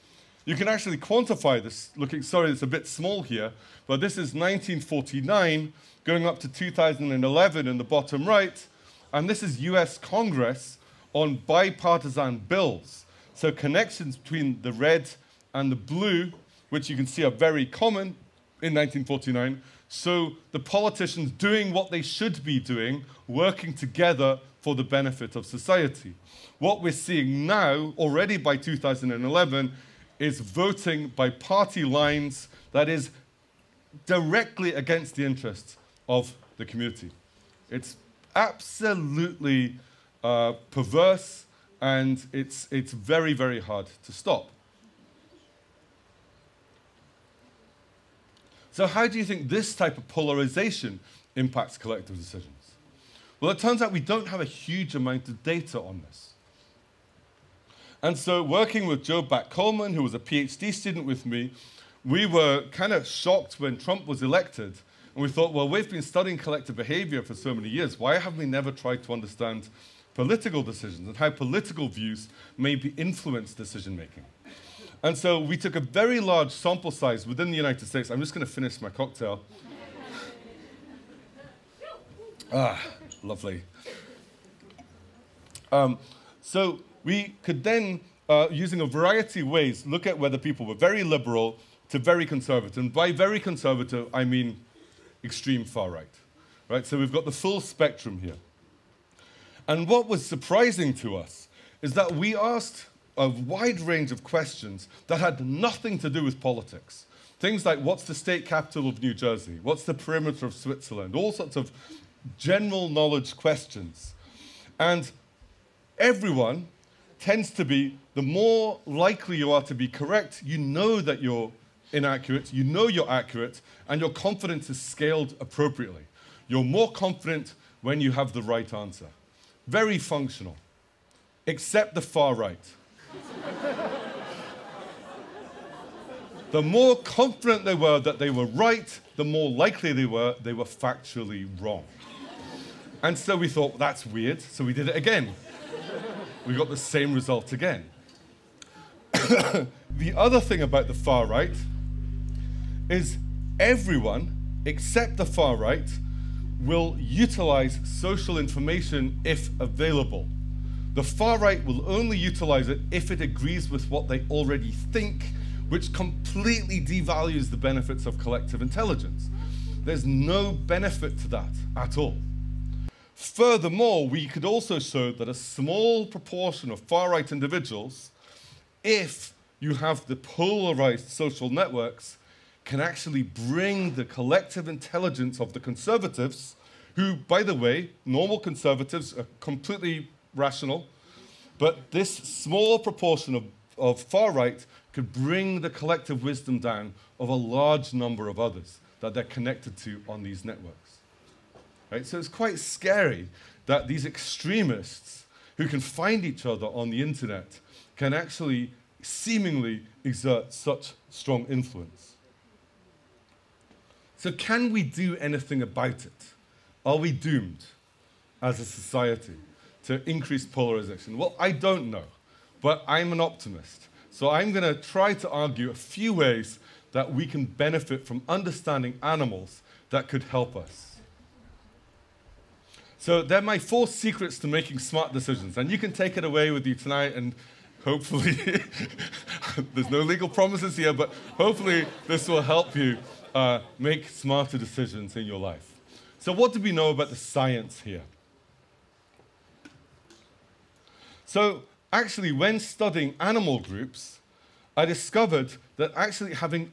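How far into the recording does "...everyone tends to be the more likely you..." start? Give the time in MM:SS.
01:55.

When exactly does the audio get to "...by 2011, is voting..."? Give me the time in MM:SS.
00:28.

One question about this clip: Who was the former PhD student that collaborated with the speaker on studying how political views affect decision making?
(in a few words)
Joe Bak-Coleman.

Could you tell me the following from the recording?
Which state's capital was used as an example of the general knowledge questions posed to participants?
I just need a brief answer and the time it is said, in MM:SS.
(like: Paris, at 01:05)
New Jersey, at 01:49.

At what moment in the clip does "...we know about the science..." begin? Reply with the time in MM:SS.
04:06.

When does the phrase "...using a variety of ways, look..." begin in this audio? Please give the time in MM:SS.
01:28.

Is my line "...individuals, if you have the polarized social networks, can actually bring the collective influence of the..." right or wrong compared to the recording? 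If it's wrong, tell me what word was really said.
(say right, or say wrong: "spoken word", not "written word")
wrong: "intelligence", not "influence".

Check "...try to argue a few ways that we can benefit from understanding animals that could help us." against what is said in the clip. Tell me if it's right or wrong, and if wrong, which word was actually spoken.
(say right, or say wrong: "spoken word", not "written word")
right.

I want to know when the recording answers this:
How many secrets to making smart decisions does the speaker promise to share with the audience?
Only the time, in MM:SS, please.
03:53.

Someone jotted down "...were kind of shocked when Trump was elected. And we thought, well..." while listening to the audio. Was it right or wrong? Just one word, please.
right.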